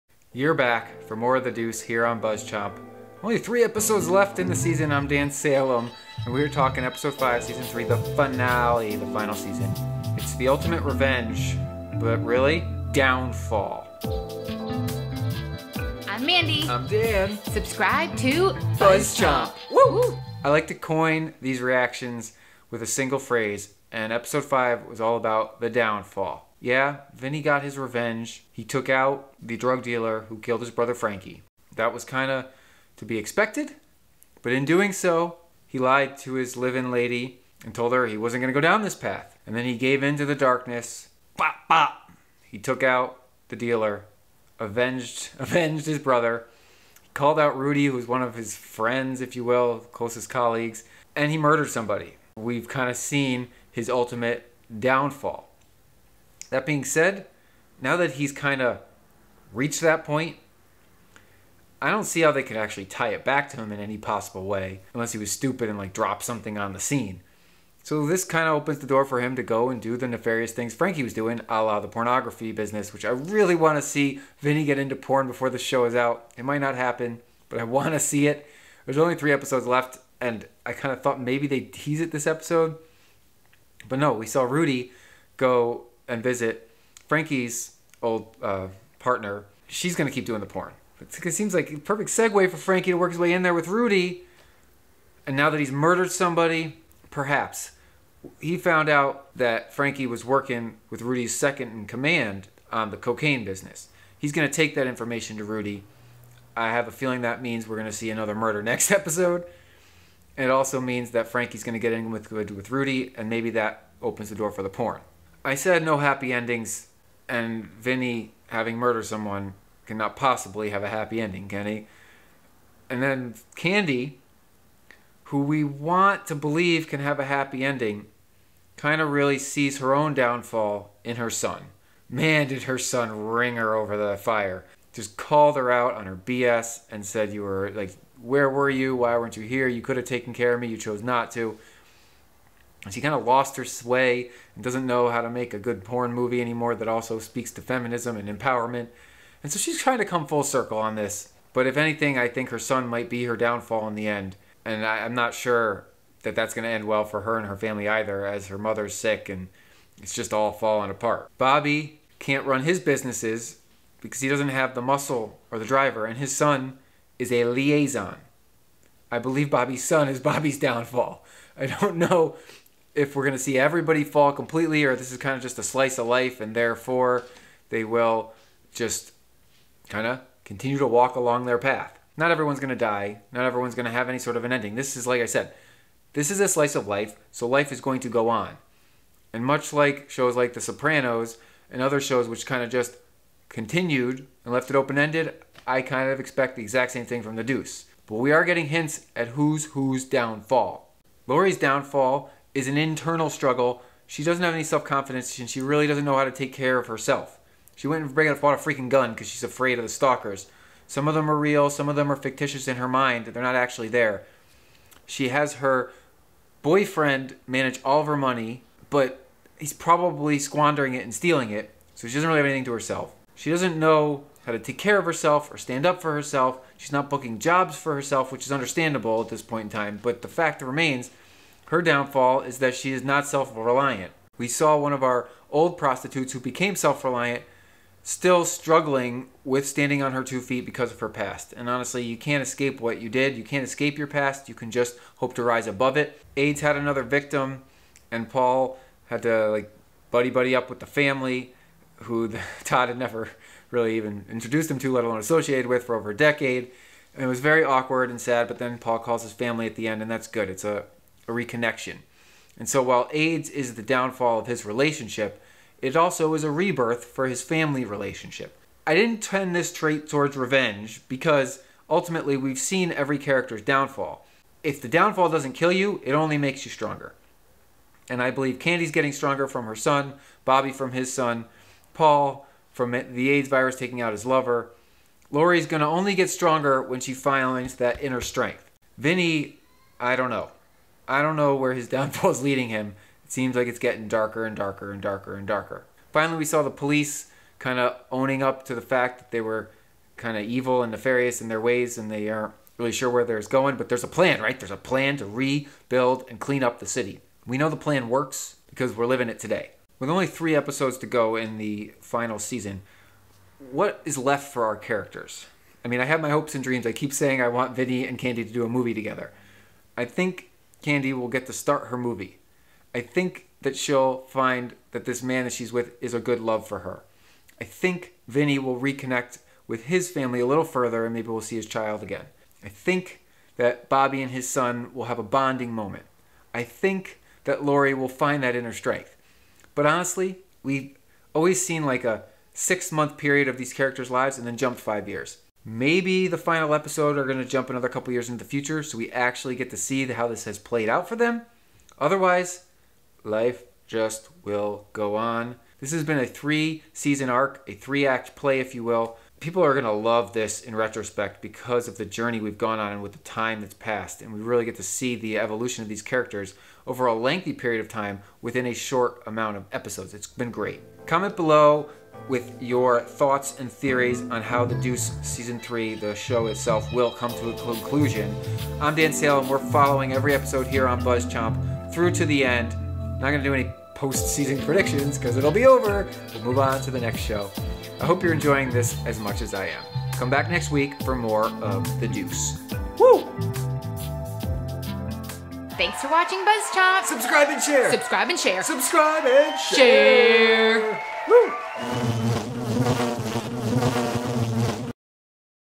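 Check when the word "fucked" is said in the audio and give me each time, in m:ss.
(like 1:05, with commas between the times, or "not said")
not said.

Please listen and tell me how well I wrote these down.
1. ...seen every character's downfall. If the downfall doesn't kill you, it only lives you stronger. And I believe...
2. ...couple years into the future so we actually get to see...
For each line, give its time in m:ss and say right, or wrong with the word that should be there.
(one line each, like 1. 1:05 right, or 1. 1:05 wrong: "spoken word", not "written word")
1. 4:32 wrong: "makes", not "lives"
2. 5:47 right.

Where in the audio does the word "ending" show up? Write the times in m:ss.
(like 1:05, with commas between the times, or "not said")
1:56, 2:01, 2:07, 3:04.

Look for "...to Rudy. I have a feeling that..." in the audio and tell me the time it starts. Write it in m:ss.
1:45.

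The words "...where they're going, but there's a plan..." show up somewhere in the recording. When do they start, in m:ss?
5:03.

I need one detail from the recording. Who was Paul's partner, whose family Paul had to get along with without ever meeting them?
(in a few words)
Todd.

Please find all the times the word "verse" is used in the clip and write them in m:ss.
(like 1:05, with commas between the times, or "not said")
not said.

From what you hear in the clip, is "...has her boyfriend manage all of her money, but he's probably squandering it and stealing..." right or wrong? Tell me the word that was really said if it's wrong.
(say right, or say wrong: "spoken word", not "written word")
right.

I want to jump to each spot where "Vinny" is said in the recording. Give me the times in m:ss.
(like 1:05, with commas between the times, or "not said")
0:27, 1:14, 1:57, 4:48, 5:17, 5:28.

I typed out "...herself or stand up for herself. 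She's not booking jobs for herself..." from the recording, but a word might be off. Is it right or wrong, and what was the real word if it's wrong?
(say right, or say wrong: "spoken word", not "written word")
right.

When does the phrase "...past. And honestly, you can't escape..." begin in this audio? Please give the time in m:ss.
4:01.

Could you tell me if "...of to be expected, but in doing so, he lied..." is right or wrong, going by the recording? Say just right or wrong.
right.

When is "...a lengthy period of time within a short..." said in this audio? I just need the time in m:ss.
6:07.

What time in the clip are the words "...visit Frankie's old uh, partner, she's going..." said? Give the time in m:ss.
1:26.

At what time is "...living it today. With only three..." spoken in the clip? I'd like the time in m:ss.
5:09.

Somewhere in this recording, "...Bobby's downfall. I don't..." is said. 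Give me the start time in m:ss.
2:50.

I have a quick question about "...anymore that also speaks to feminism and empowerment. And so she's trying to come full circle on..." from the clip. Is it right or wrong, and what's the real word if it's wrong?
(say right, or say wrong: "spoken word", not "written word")
right.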